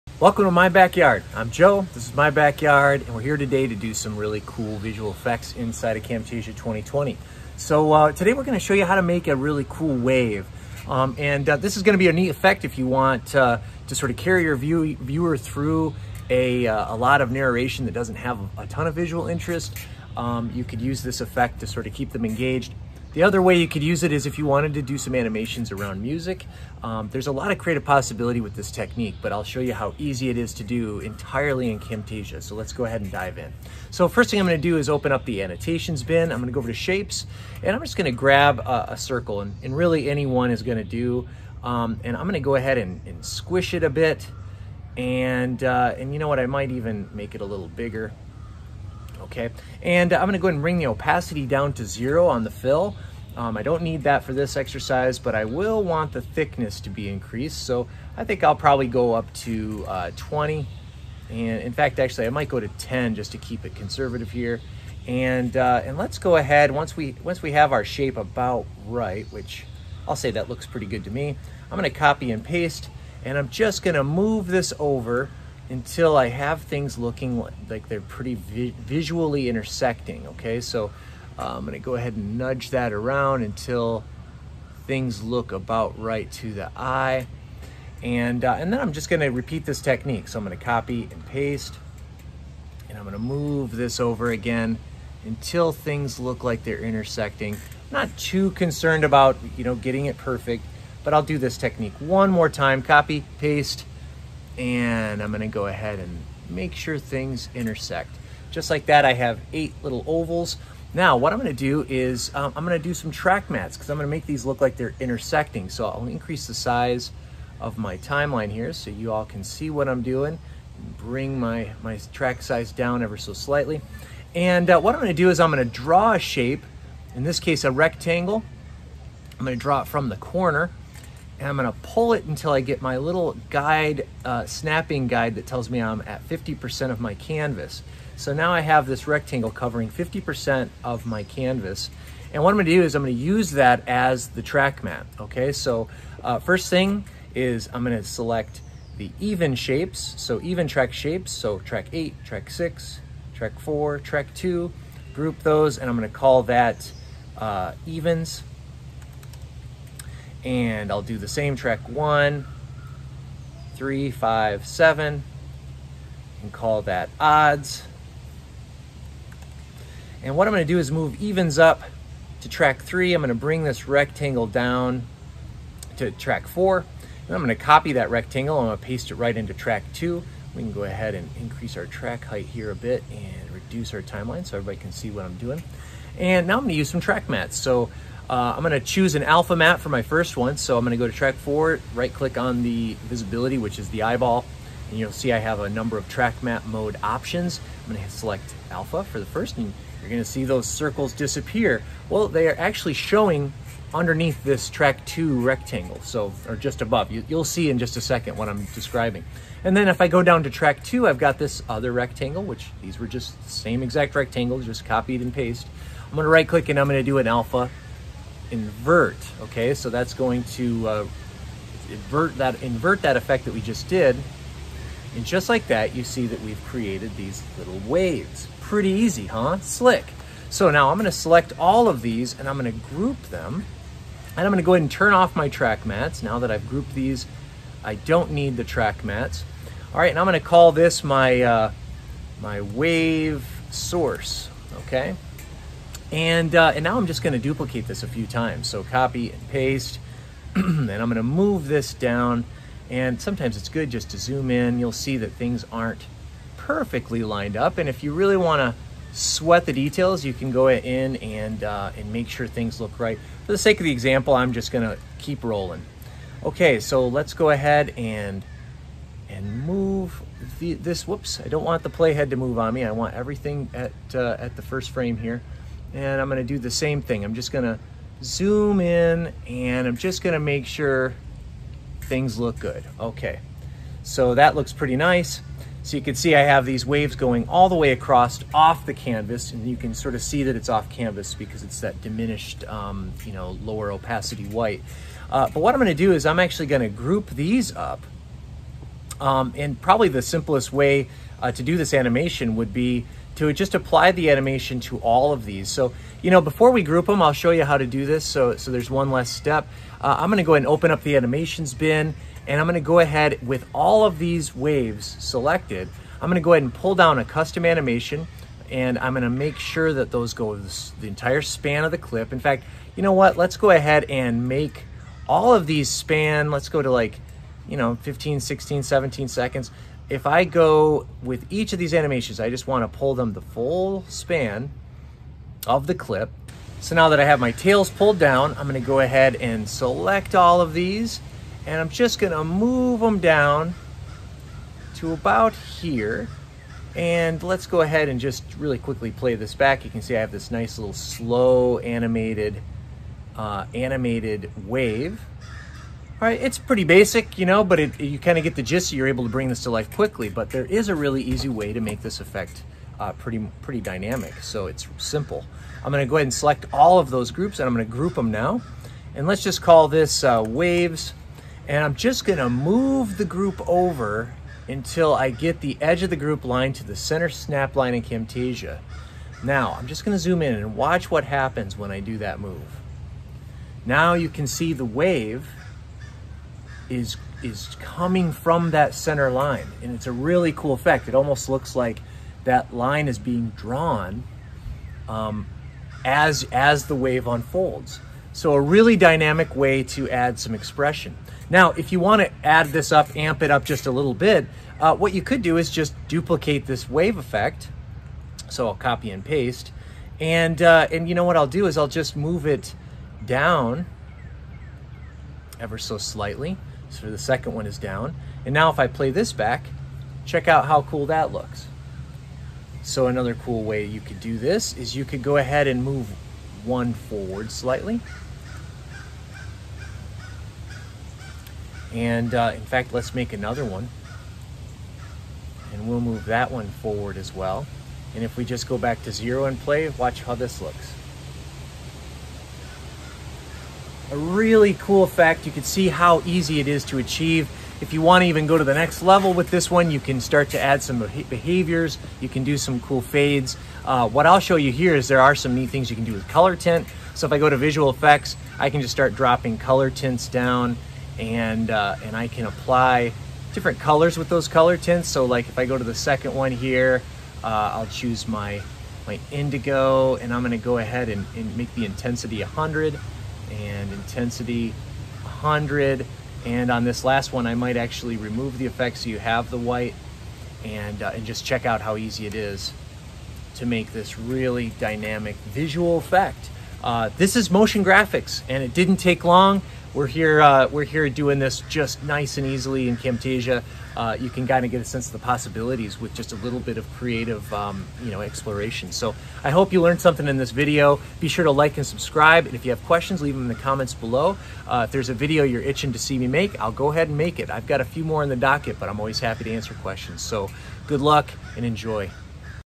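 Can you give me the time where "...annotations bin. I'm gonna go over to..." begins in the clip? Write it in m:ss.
0:35.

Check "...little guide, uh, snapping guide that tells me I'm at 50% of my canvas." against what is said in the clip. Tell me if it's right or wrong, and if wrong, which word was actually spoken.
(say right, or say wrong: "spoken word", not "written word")
right.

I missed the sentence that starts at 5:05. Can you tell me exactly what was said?
So, you know, before we group them, I'll show you how to do this.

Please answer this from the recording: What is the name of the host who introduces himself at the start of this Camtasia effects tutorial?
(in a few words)
Joe.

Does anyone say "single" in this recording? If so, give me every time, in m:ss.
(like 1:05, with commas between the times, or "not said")
not said.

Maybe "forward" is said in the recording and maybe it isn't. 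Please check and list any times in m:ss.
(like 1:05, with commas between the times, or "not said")
7:06, 7:16.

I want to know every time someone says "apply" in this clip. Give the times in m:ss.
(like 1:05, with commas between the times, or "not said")
5:03, 7:42.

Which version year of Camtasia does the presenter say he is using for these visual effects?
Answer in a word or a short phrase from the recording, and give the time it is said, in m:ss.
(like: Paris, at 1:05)
2020, at 0:06.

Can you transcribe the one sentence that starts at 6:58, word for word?
And now if I play this back, check out how cool that looks.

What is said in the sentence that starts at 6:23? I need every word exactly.
Now you can see the wave is is coming from that center line.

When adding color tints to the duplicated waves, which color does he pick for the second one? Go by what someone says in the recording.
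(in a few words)
indigo.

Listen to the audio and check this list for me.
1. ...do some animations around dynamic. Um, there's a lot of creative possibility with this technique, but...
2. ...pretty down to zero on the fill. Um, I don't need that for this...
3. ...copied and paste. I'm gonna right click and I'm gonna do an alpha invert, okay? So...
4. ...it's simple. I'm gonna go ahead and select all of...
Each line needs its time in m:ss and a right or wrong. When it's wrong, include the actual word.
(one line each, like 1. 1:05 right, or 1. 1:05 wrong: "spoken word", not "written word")
1. 0:24 wrong: "music", not "dynamic"
2. 0:50 wrong: "opacity", not "pretty"
3. 3:34 right
4. 6:04 right.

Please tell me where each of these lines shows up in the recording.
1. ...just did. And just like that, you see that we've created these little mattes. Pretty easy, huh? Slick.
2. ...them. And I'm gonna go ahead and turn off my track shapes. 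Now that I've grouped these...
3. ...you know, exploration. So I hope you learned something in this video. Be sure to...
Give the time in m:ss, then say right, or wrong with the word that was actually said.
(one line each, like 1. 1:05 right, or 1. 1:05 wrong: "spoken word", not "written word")
1. 3:43 wrong: "waves", not "mattes"
2. 3:53 wrong: "mattes", not "shapes"
3. 8:18 right.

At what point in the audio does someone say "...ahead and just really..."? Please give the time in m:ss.
5:47.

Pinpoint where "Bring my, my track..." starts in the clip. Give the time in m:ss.
2:00.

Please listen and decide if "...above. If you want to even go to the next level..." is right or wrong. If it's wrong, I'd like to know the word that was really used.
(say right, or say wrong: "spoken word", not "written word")
wrong: "achieve", not "above".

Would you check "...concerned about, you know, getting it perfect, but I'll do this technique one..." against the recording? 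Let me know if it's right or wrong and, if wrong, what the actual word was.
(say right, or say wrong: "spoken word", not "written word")
right.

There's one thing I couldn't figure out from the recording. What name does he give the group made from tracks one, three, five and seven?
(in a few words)
odds.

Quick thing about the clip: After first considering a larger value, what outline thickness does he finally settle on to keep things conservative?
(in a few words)
10.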